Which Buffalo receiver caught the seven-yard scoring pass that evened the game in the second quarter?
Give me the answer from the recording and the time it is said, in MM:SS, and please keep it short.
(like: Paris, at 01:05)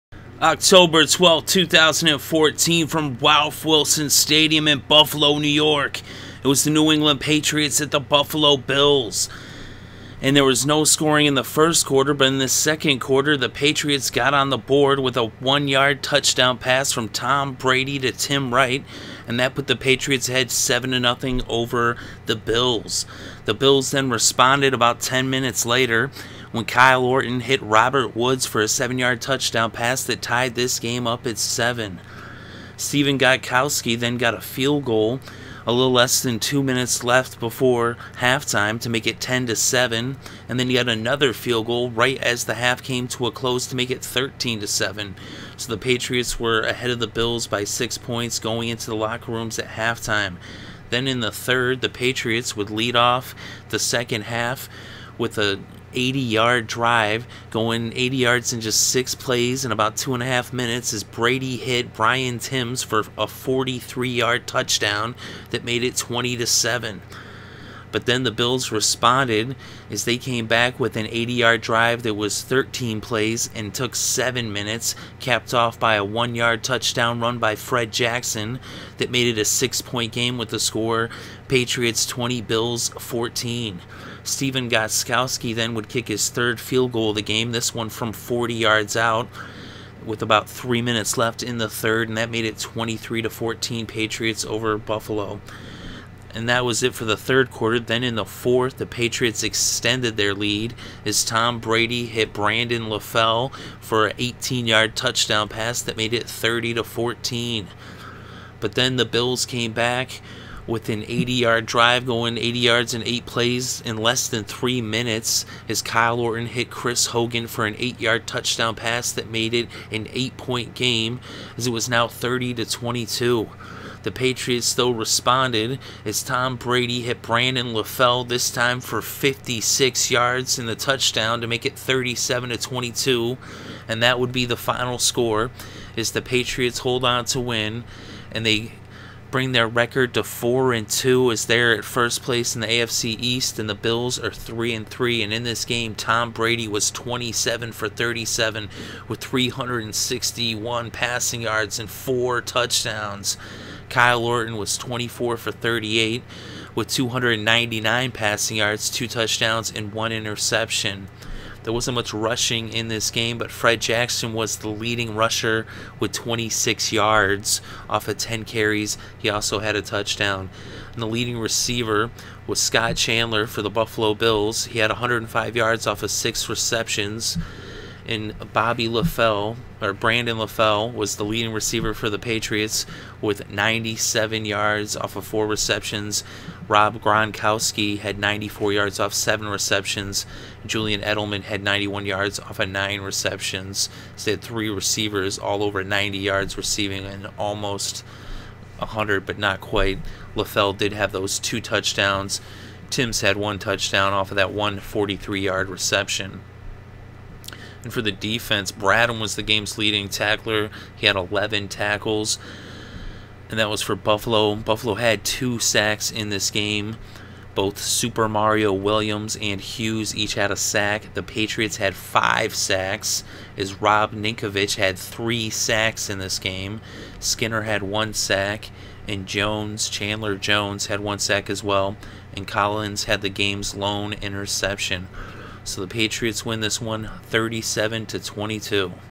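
Robert Woods, at 00:27.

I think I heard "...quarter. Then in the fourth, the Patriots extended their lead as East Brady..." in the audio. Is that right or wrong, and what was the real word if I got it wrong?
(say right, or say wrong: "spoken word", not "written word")
wrong: "Tom", not "East".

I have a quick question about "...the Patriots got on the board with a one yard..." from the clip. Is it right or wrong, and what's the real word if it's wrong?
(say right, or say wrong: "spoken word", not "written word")
right.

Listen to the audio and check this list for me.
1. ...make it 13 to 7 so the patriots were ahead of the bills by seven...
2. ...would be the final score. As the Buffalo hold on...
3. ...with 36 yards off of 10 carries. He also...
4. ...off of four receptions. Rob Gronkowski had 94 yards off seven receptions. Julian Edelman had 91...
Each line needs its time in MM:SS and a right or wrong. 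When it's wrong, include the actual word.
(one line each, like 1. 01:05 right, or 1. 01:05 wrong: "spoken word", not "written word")
1. 00:43 wrong: "six", not "seven"
2. 02:14 wrong: "Patriots", not "Buffalo"
3. 02:45 wrong: "26", not "36"
4. 03:04 right.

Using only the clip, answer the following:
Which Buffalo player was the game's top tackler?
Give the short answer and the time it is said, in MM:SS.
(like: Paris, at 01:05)
Bradham, at 03:28.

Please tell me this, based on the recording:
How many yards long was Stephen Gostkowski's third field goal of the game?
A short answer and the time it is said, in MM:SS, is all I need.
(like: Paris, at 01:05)
40 yards, at 01:28.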